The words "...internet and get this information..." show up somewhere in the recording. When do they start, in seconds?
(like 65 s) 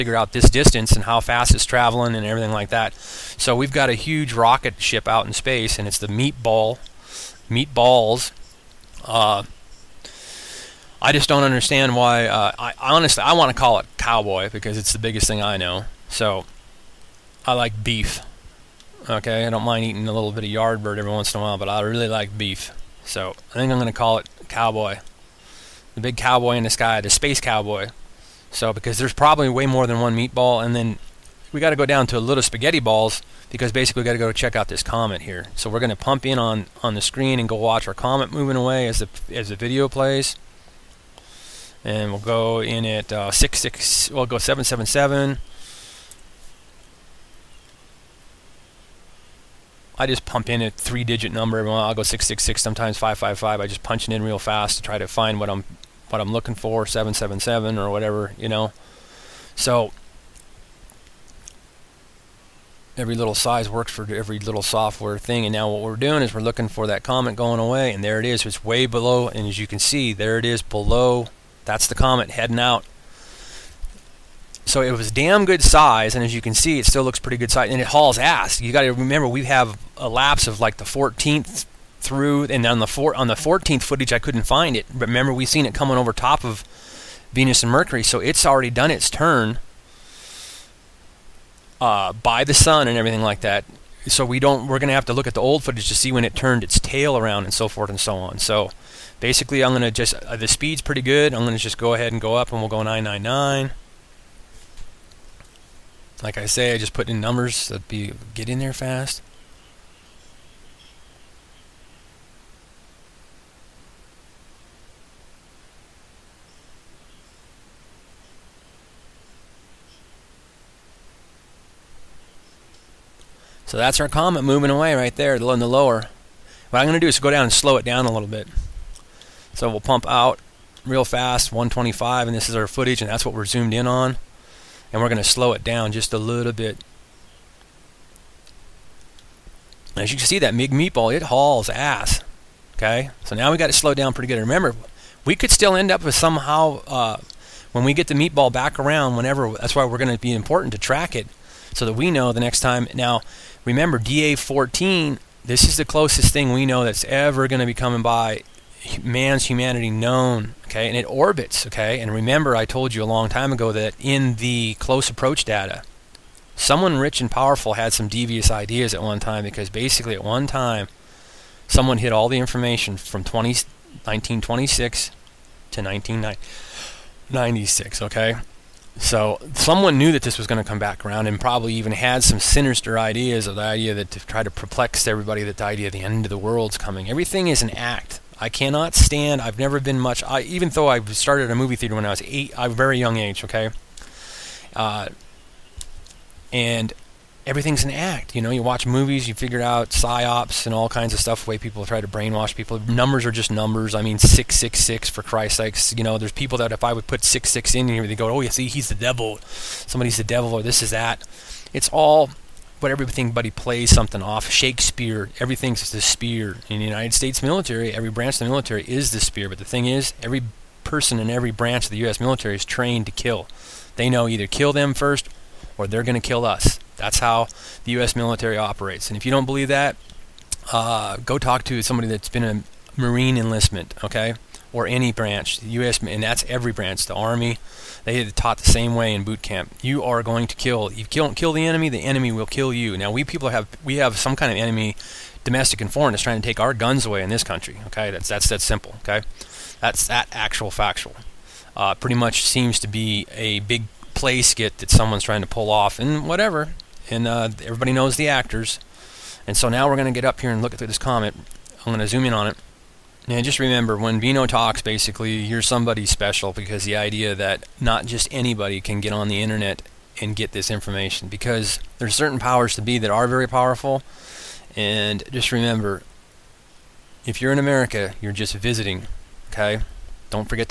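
269 s.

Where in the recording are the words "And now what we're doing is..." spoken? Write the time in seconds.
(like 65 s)
65 s.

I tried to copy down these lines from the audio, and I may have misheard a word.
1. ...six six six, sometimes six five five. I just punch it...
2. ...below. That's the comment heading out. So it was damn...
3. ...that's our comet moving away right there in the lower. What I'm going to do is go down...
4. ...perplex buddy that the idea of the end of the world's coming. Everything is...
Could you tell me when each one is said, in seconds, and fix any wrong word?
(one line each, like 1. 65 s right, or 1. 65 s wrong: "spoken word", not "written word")
1. 52 s wrong: "five", not "six"
2. 70 s right
3. 123 s right
4. 184 s wrong: "everybody", not "buddy".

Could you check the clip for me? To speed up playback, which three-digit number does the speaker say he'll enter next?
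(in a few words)
999.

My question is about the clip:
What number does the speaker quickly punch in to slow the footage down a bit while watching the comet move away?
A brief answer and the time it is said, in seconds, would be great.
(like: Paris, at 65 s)
125, at 131 s.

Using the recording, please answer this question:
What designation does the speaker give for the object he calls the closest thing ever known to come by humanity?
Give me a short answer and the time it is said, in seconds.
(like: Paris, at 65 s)
DA14, at 153 s.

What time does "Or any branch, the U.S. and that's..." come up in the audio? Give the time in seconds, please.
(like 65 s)
234 s.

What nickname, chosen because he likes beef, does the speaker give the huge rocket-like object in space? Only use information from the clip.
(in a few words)
the space cowboy.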